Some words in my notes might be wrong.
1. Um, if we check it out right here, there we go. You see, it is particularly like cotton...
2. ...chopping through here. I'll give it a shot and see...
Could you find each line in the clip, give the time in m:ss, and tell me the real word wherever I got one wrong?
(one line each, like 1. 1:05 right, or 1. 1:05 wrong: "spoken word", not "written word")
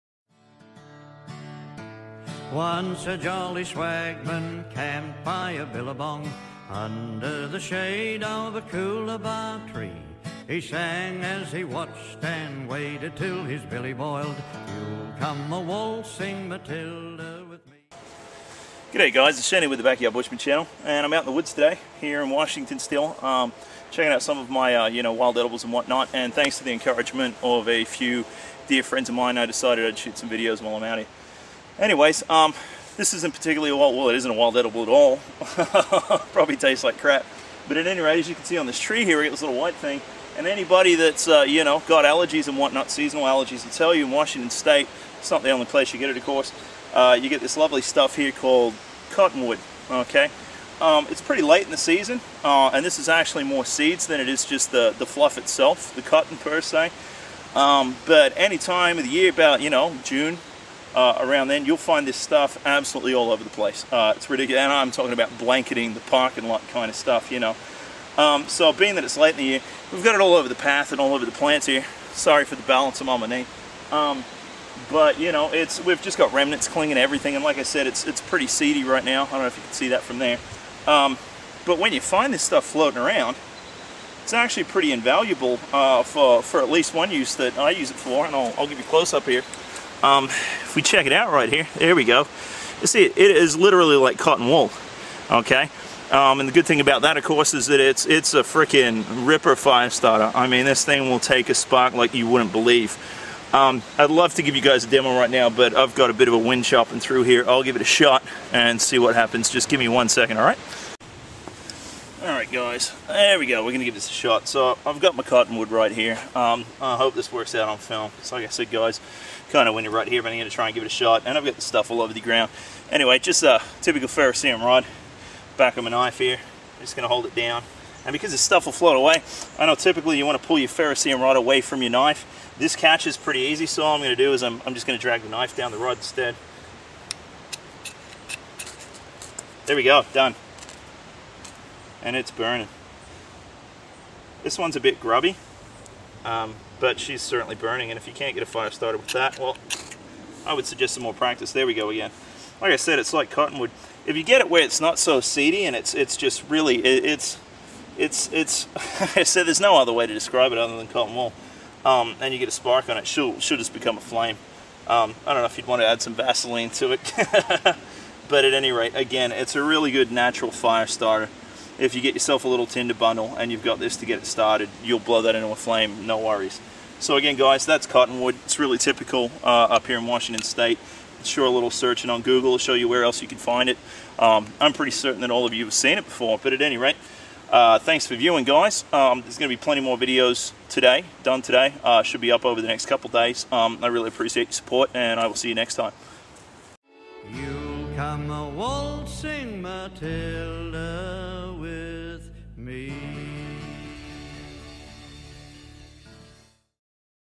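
1. 1:30 wrong: "literally", not "particularly"
2. 1:46 right.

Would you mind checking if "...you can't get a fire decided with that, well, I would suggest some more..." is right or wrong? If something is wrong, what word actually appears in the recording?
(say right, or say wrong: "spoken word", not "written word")
wrong: "started", not "decided".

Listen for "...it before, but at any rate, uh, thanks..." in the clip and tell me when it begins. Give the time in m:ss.
3:05.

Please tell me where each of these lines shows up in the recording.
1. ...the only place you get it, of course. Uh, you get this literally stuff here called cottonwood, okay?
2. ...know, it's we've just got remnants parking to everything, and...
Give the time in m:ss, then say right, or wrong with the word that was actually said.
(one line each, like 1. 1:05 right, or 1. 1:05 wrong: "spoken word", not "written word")
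1. 0:45 wrong: "lovely", not "literally"
2. 1:15 wrong: "clinging", not "parking".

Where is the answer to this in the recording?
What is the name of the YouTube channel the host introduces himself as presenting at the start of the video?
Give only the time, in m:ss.
0:19.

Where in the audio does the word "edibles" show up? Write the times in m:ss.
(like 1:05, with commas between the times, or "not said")
0:25, 0:34.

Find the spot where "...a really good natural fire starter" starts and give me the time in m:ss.
2:49.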